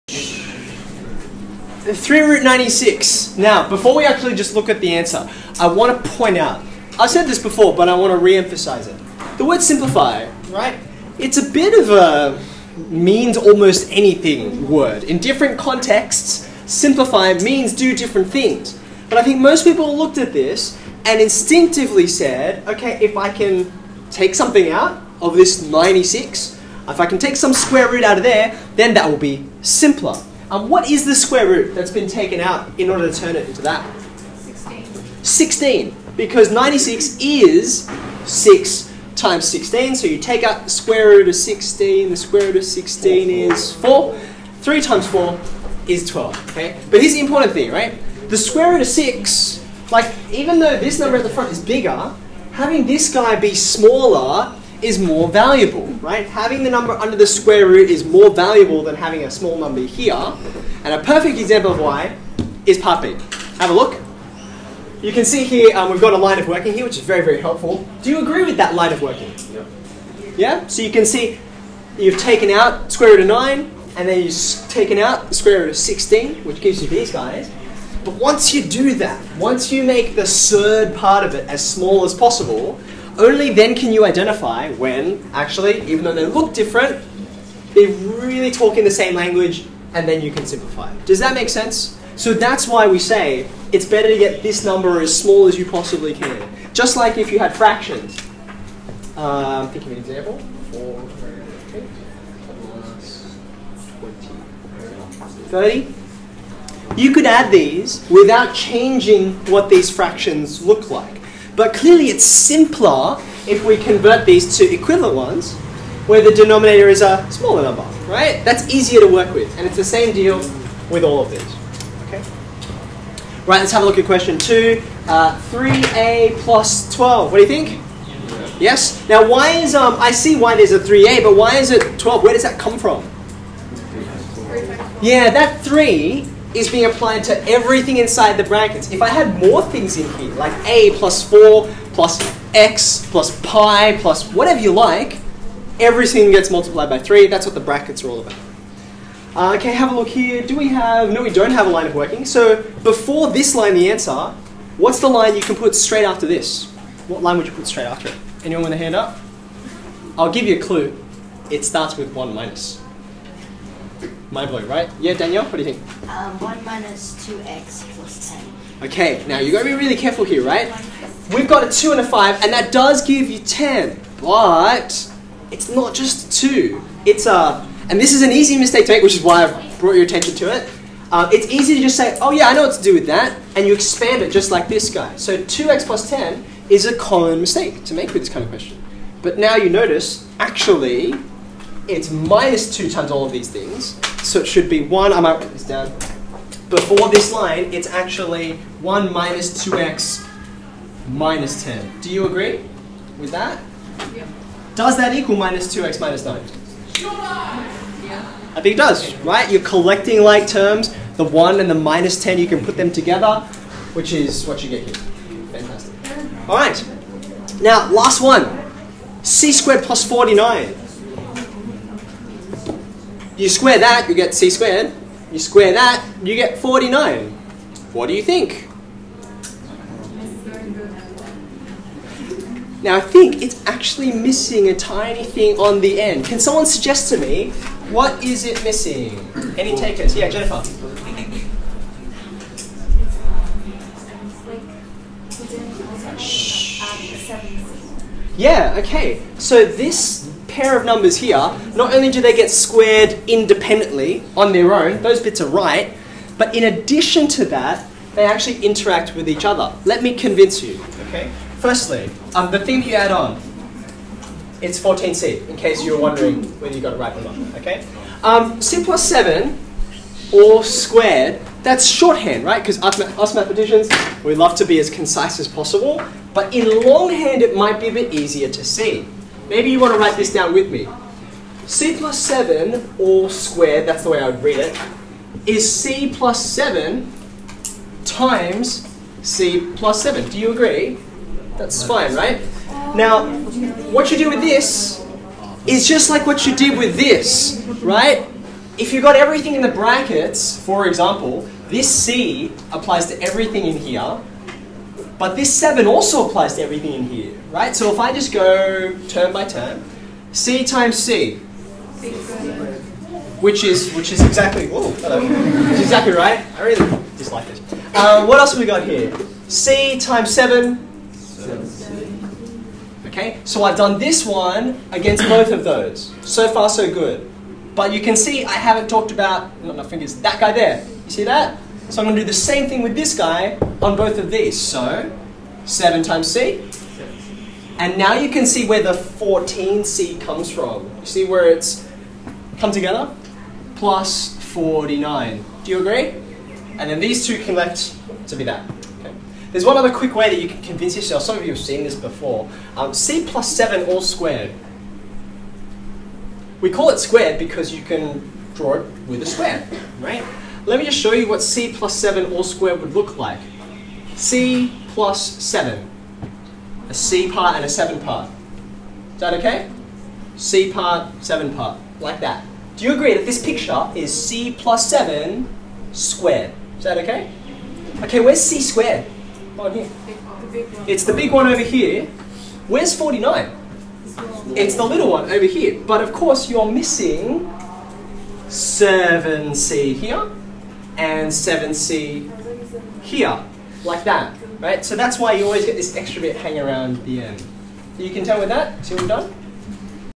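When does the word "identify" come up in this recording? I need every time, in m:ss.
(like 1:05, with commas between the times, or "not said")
1:24.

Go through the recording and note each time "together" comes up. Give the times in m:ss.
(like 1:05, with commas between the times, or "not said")
3:32, 5:42.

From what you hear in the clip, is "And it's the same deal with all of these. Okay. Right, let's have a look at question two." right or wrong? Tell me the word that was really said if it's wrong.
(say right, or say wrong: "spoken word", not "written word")
right.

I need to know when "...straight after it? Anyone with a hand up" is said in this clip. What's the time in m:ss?
2:37.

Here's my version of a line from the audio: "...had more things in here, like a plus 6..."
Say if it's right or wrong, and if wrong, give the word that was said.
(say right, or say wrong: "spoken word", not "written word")
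wrong: "4", not "6".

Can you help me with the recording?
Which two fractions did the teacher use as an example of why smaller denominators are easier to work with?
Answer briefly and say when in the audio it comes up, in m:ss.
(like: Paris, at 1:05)
4/8 and 20/30, at 1:40.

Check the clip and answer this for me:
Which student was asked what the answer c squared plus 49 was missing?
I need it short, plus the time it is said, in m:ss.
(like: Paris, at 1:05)
Jennifer, at 4:00.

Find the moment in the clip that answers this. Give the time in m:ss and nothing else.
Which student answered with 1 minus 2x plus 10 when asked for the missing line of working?
2:45.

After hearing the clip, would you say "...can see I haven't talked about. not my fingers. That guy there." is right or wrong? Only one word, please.
right.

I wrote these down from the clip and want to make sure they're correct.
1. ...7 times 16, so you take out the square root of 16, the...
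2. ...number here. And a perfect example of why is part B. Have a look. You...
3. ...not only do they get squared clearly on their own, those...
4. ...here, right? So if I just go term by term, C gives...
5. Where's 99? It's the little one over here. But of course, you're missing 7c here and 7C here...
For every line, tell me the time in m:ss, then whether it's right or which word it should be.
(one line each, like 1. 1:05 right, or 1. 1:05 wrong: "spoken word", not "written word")
1. 0:38 wrong: "6", not "7"
2. 0:59 right
3. 4:11 wrong: "independently", not "clearly"
4. 5:07 wrong: "times", not "gives"
5. 6:22 wrong: "49", not "99".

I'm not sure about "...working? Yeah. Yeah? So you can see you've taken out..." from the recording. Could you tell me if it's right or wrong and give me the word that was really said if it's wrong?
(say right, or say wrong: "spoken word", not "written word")
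right.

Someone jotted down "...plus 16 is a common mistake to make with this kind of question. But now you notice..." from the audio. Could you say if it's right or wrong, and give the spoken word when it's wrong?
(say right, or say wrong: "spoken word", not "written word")
wrong: "10", not "16".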